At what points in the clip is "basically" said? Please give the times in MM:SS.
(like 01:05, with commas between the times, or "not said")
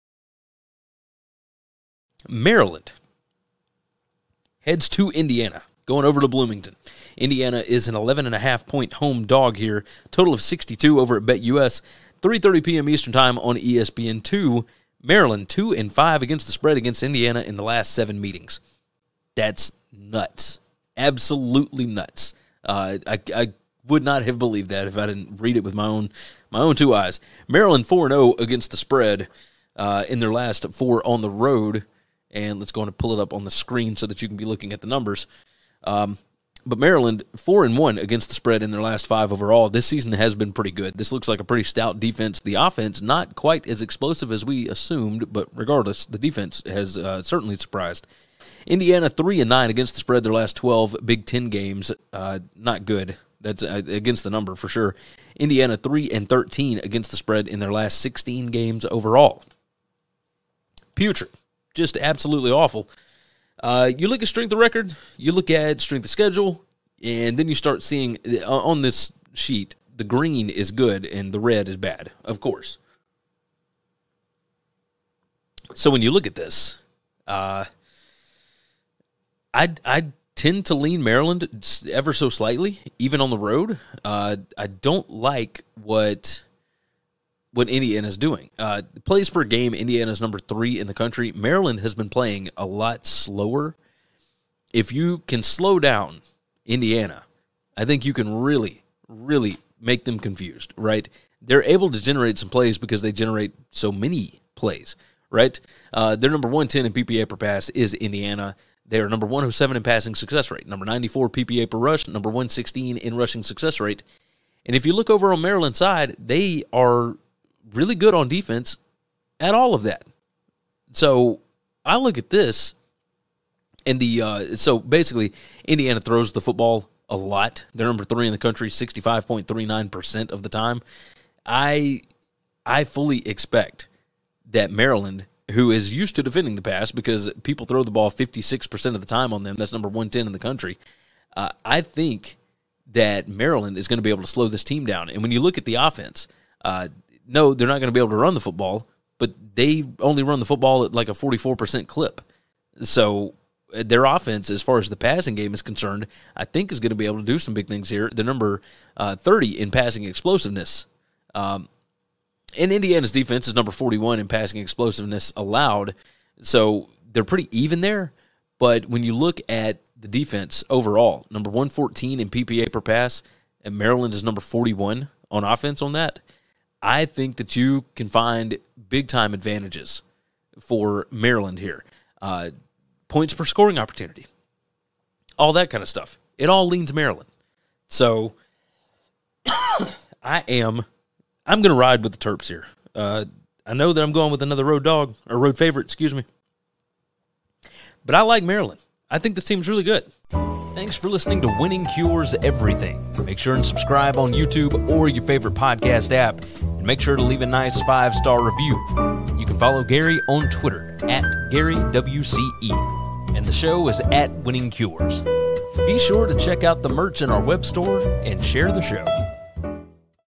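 02:04.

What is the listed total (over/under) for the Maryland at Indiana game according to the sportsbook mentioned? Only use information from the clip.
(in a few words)
62.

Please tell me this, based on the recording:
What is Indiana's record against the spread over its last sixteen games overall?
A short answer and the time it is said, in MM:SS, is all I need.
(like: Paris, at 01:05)
3-13, at 00:55.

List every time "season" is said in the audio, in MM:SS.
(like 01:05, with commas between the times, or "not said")
00:39.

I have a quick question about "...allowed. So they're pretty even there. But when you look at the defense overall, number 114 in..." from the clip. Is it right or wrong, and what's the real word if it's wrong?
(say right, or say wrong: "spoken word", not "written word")
right.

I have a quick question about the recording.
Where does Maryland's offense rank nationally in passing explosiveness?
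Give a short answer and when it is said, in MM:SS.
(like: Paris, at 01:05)
30, at 02:38.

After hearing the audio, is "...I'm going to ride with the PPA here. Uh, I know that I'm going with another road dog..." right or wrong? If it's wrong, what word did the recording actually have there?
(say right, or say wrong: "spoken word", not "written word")
wrong: "Terps", not "PPA".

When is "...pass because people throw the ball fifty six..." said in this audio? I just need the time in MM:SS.
02:16.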